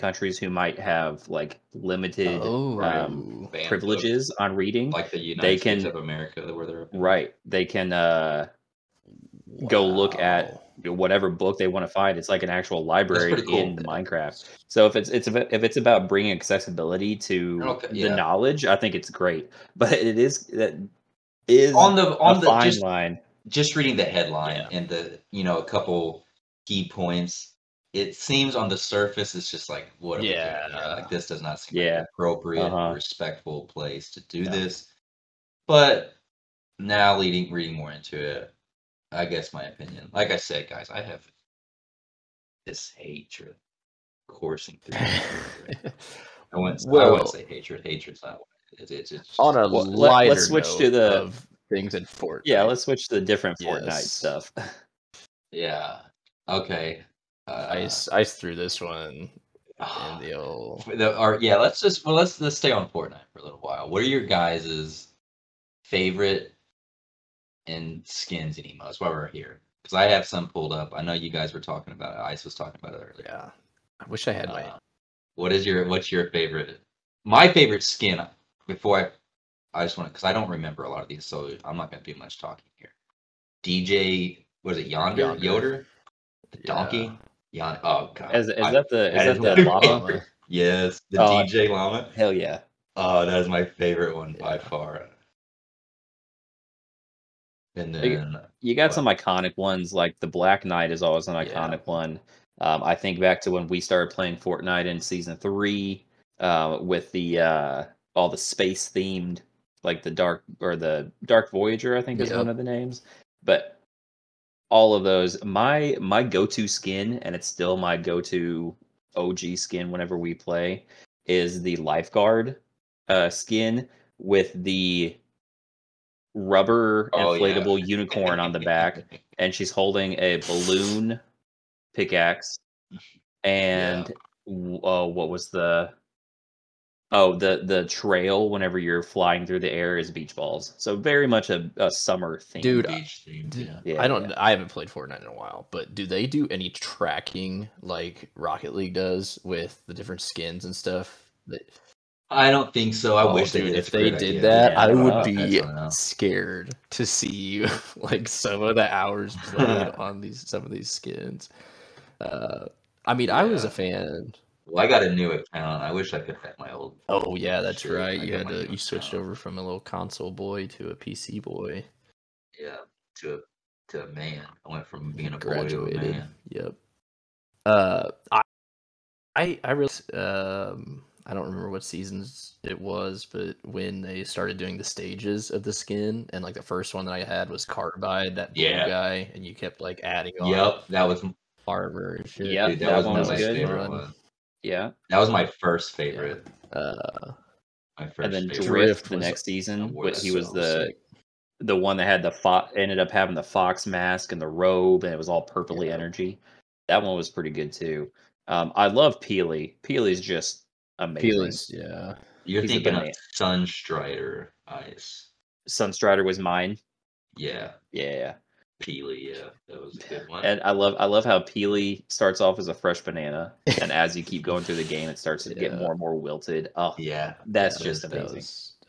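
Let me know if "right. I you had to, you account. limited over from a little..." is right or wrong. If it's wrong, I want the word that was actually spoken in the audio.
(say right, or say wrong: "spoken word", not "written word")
wrong: "switched", not "limited".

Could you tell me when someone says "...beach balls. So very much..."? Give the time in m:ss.
2:20.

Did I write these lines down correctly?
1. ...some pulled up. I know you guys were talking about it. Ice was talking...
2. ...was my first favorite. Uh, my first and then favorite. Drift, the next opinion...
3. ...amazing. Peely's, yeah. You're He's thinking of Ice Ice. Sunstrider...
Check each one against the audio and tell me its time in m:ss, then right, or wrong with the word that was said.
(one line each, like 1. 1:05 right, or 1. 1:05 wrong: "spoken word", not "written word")
1. 1:10 right
2. 3:15 wrong: "season", not "opinion"
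3. 3:30 wrong: "Sunstrider", not "Ice".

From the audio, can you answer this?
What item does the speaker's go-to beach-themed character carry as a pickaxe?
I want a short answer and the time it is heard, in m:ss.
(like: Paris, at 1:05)
Balloon pickaxe, at 2:10.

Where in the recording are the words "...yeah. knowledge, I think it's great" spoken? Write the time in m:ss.
0:17.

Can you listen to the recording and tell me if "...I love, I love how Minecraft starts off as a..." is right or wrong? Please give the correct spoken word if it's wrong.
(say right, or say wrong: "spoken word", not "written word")
wrong: "Peely", not "Minecraft".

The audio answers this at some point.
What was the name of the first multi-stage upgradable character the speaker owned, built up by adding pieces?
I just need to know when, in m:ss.
3:07.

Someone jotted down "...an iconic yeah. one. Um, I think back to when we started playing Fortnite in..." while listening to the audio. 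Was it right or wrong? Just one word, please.
right.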